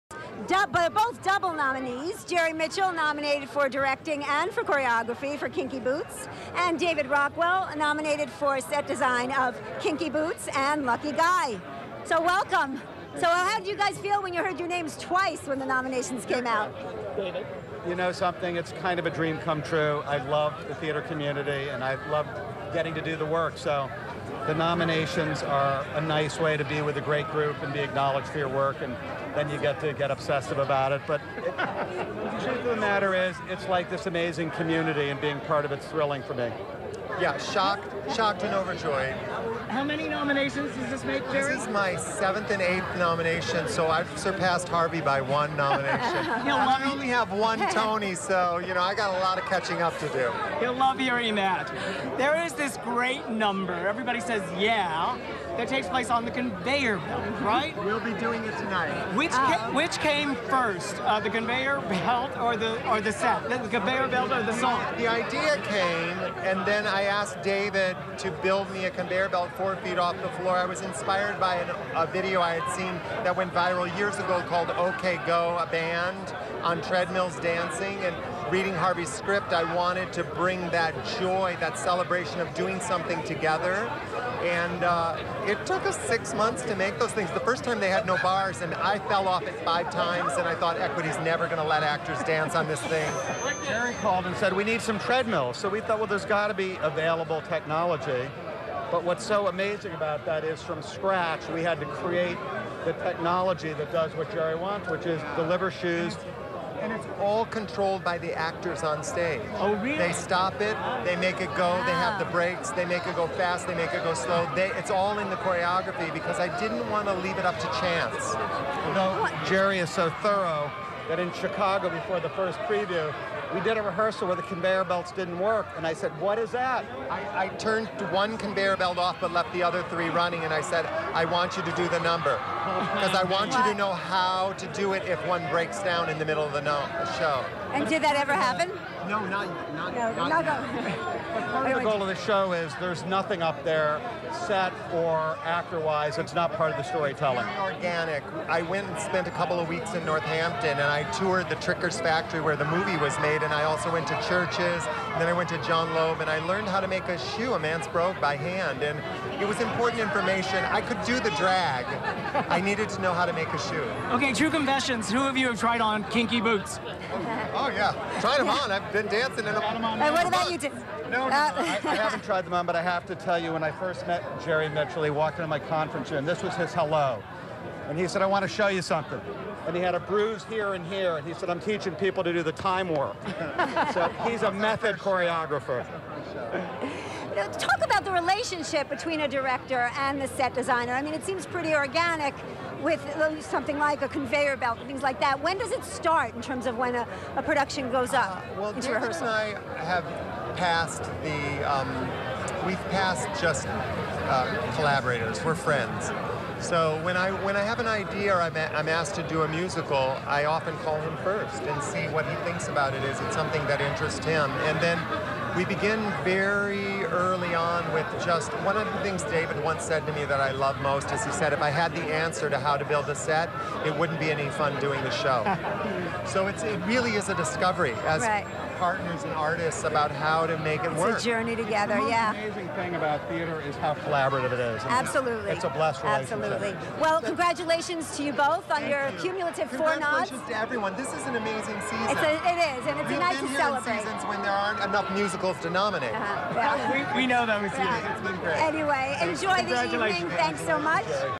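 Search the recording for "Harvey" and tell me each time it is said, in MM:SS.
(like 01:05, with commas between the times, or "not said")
00:44, 01:18.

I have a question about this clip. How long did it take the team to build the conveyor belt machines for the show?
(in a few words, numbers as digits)
6 months.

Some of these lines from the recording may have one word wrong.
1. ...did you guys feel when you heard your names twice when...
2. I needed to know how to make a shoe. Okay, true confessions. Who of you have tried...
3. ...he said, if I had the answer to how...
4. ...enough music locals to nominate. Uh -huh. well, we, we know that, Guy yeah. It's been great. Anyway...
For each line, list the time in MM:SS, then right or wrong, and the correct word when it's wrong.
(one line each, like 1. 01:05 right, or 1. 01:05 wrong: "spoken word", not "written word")
1. 00:13 right
2. 02:42 right
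3. 03:41 right
4. 04:04 wrong: "Miss", not "Guy".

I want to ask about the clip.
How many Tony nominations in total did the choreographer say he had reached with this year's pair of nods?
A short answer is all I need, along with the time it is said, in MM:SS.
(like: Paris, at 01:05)
8, at 00:42.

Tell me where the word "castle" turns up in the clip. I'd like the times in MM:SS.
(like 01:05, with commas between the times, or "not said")
not said.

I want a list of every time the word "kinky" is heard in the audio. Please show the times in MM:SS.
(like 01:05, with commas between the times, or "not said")
00:05, 00:09, 02:46.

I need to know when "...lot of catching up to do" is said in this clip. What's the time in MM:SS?
00:49.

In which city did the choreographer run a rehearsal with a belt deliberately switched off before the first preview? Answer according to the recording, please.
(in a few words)
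Chicago.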